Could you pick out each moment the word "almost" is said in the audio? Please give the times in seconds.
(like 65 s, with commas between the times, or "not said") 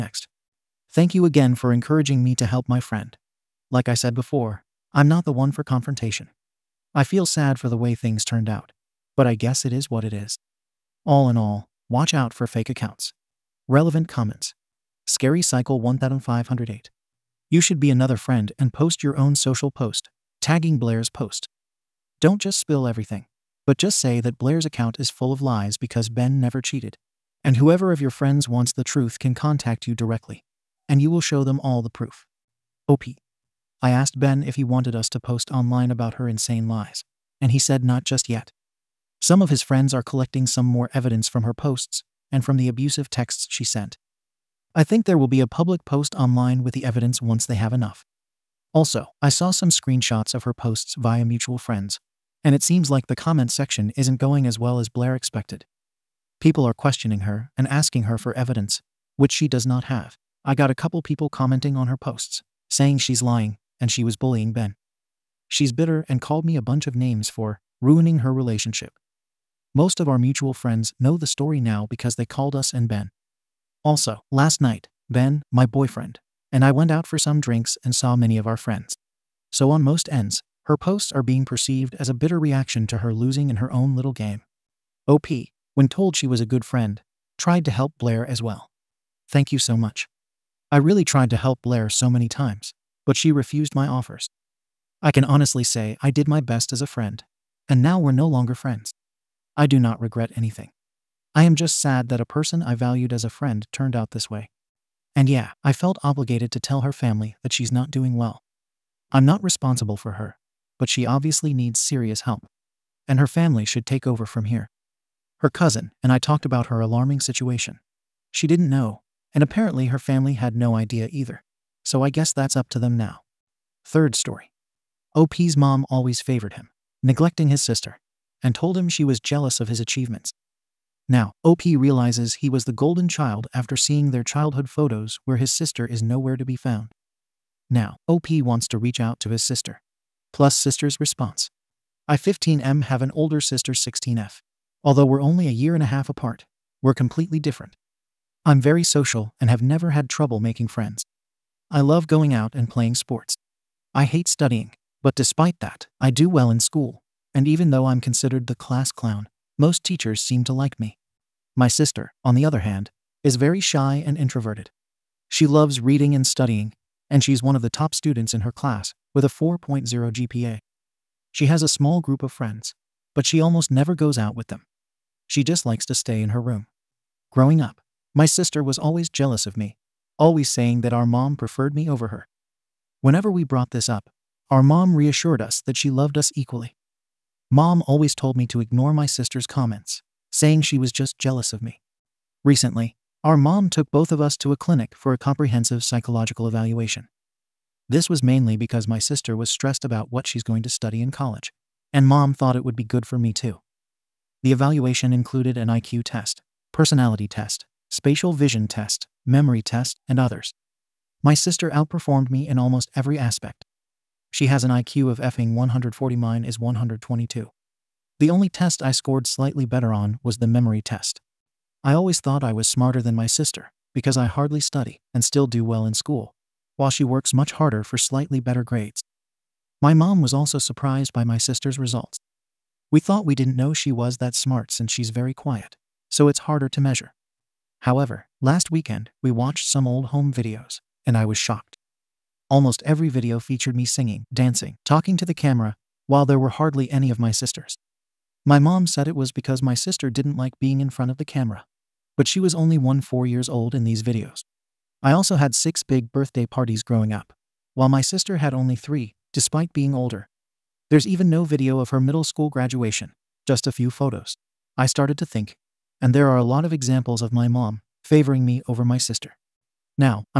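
173 s, 212 s, 242 s.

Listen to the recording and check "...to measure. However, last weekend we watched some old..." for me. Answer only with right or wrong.
right.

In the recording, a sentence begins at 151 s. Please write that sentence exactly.
I love going out and playing sports.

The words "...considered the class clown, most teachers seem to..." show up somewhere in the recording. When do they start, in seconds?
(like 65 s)
157 s.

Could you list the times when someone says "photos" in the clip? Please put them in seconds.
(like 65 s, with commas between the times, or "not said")
134 s, 263 s.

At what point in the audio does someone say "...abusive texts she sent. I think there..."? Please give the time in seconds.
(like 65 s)
42 s.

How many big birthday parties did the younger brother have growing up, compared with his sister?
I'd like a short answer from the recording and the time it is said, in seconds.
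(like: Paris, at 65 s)
6, at 255 s.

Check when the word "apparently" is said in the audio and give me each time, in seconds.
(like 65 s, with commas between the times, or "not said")
119 s.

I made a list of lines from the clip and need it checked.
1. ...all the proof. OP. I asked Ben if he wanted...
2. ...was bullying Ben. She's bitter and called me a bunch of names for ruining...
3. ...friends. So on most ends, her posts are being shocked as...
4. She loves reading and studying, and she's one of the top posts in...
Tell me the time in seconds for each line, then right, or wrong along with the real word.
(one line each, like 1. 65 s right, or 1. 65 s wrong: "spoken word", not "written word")
1. 31 s right
2. 64 s right
3. 78 s wrong: "perceived", not "shocked"
4. 165 s wrong: "students", not "posts".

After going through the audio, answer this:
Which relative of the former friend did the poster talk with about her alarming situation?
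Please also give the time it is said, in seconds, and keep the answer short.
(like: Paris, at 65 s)
Her cousin, at 115 s.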